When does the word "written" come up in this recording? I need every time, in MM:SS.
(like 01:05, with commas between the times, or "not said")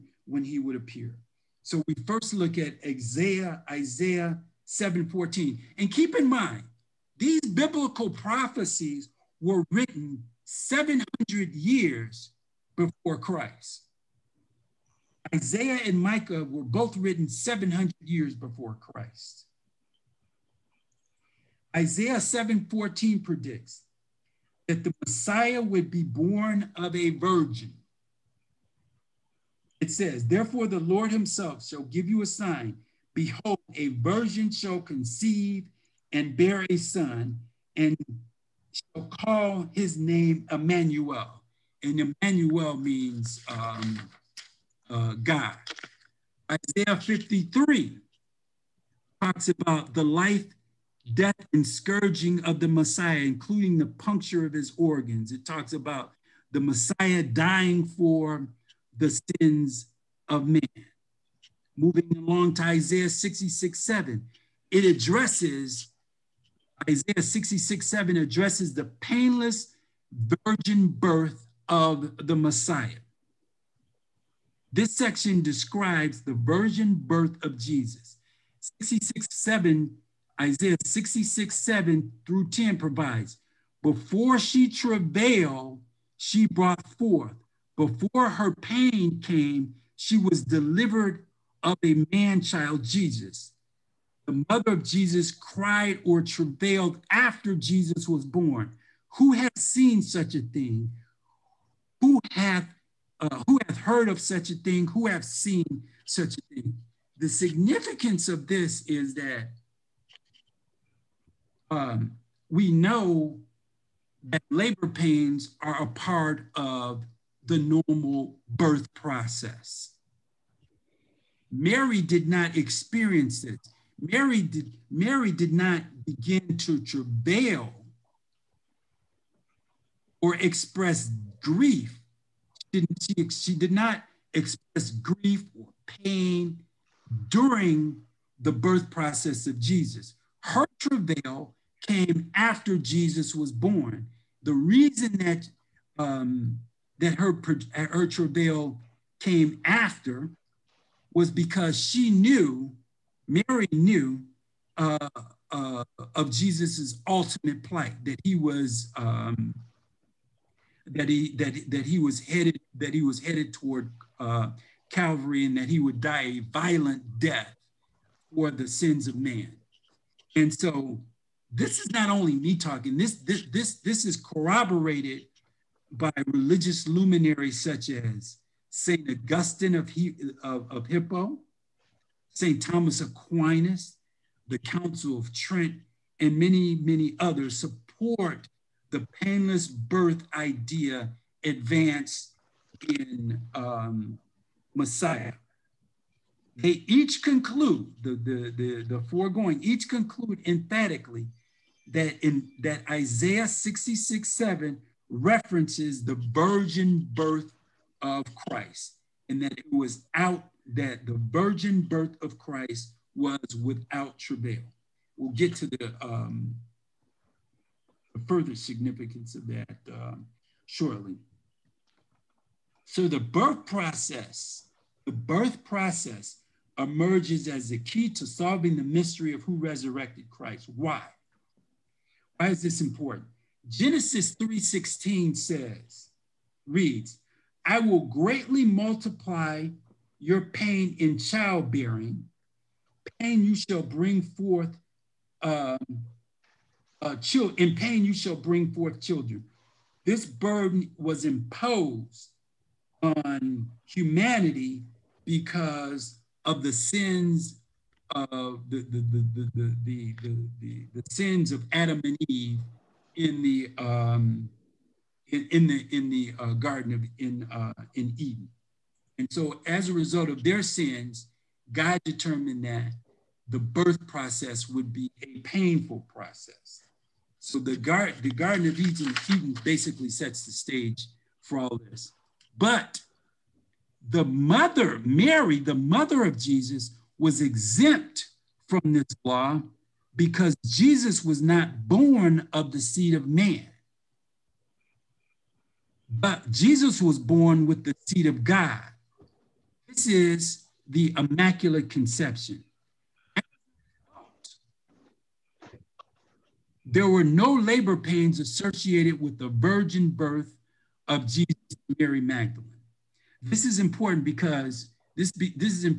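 00:09, 00:16.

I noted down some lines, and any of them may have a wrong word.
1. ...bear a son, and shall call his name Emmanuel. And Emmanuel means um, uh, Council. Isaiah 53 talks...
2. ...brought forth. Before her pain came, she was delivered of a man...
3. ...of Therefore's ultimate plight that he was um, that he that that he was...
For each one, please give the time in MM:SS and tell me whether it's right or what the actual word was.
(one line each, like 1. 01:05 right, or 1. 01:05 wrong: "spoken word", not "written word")
1. 00:36 wrong: "God", not "Council"
2. 01:26 right
3. 02:36 wrong: "Jesus", not "Therefore".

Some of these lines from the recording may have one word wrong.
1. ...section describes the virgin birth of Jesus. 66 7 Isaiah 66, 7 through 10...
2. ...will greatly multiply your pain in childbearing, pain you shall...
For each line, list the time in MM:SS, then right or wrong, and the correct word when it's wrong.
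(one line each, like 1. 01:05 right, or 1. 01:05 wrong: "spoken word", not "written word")
1. 01:14 right
2. 03:57 right.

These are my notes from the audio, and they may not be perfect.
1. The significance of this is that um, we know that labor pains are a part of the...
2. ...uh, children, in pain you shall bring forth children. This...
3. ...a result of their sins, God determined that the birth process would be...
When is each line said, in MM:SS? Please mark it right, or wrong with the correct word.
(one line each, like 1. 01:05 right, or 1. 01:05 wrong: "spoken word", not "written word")
1. 01:47 right
2. 04:07 right
3. 04:29 right.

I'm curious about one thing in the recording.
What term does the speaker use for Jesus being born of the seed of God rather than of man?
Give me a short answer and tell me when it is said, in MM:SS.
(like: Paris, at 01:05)
Immaculate Conception, at 05:01.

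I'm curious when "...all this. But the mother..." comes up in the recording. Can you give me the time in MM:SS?
04:41.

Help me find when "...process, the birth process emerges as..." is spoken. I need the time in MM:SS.
03:43.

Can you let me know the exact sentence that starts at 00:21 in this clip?
Isaiah 7:14 predicts that the Messiah would be born of a virgin.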